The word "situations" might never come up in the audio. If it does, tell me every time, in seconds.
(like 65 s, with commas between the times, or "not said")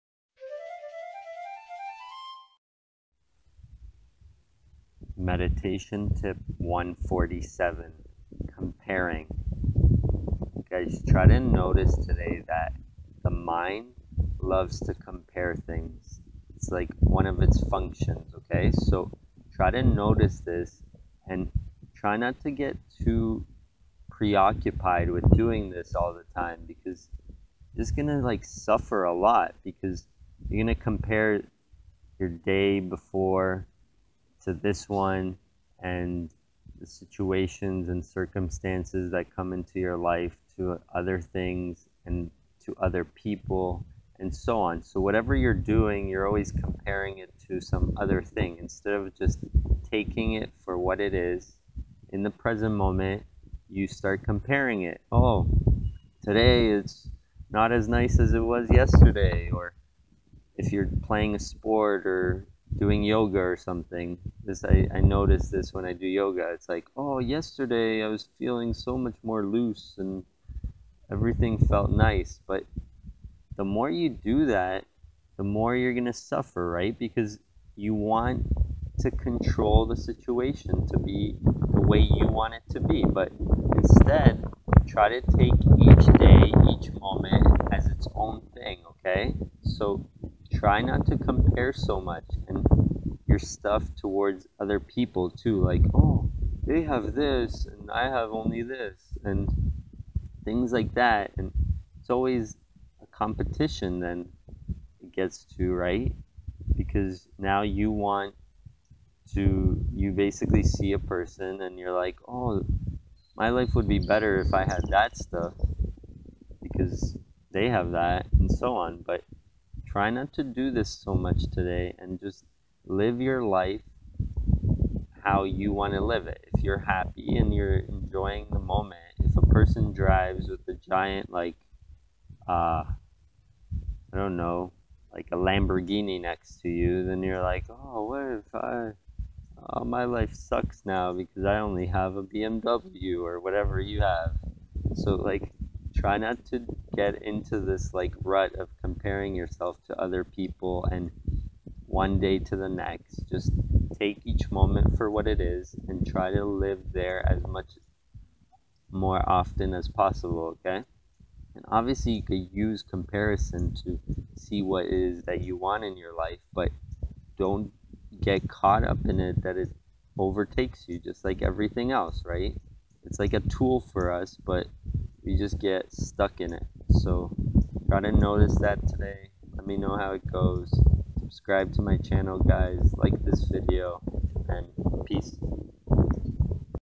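36 s, 79 s.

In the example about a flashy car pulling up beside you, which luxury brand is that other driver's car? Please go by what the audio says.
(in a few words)
Lamborghini.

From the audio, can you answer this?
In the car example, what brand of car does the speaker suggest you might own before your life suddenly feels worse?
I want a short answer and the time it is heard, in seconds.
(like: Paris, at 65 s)
BMW, at 142 s.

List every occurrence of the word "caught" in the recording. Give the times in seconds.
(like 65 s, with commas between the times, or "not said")
168 s.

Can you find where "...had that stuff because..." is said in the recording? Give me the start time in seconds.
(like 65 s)
114 s.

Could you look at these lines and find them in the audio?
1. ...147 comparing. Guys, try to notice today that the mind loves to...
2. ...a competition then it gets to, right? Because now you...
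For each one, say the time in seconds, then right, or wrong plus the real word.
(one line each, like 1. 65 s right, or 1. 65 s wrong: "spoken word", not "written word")
1. 6 s right
2. 103 s right.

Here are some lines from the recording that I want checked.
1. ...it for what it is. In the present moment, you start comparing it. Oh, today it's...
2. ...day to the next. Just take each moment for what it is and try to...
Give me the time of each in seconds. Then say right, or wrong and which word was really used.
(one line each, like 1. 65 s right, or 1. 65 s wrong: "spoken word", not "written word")
1. 50 s right
2. 152 s right.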